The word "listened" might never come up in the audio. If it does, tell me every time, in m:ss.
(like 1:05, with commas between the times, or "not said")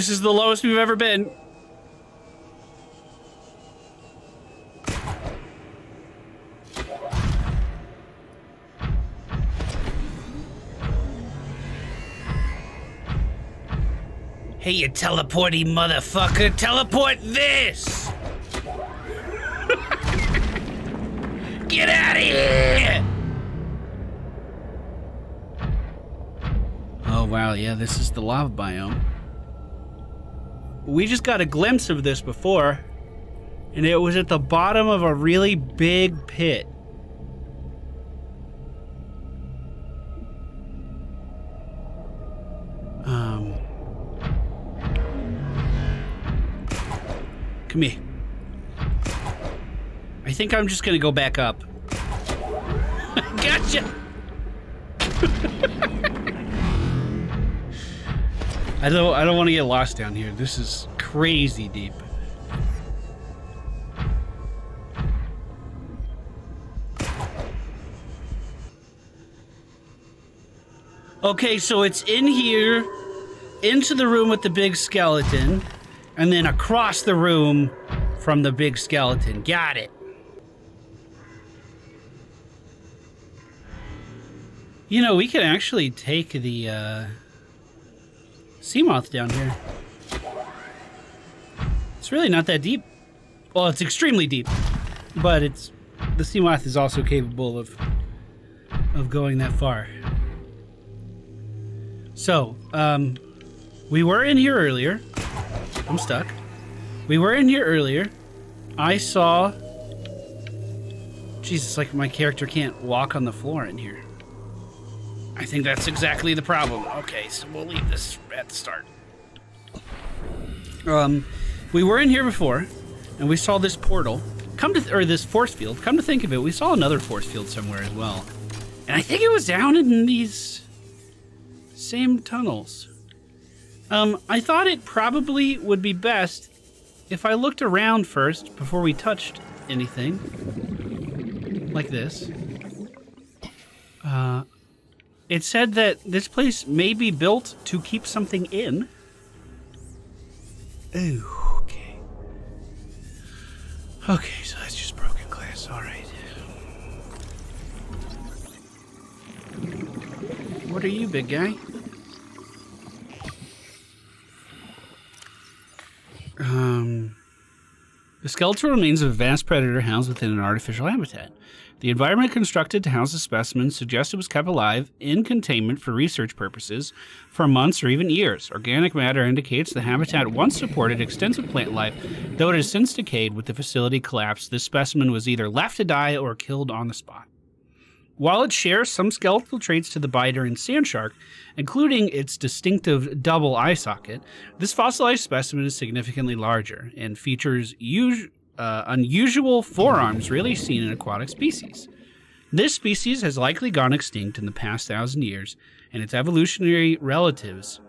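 not said.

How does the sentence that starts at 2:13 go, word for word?
Um, I thought it probably would be best if I looked around first before we touched anything like this.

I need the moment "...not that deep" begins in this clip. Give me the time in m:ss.
1:32.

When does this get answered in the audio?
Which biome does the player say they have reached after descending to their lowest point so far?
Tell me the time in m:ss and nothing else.
0:28.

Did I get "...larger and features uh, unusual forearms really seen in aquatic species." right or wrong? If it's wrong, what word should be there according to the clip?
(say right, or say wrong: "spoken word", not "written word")
right.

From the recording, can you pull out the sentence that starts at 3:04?
This specimen was either left to die or killed on the spot.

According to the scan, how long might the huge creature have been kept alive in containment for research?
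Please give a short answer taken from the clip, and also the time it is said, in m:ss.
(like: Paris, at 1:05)
Months or even years, at 2:57.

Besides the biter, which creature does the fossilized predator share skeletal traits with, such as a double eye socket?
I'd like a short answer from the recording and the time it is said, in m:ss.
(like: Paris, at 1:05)
Sand shark, at 3:10.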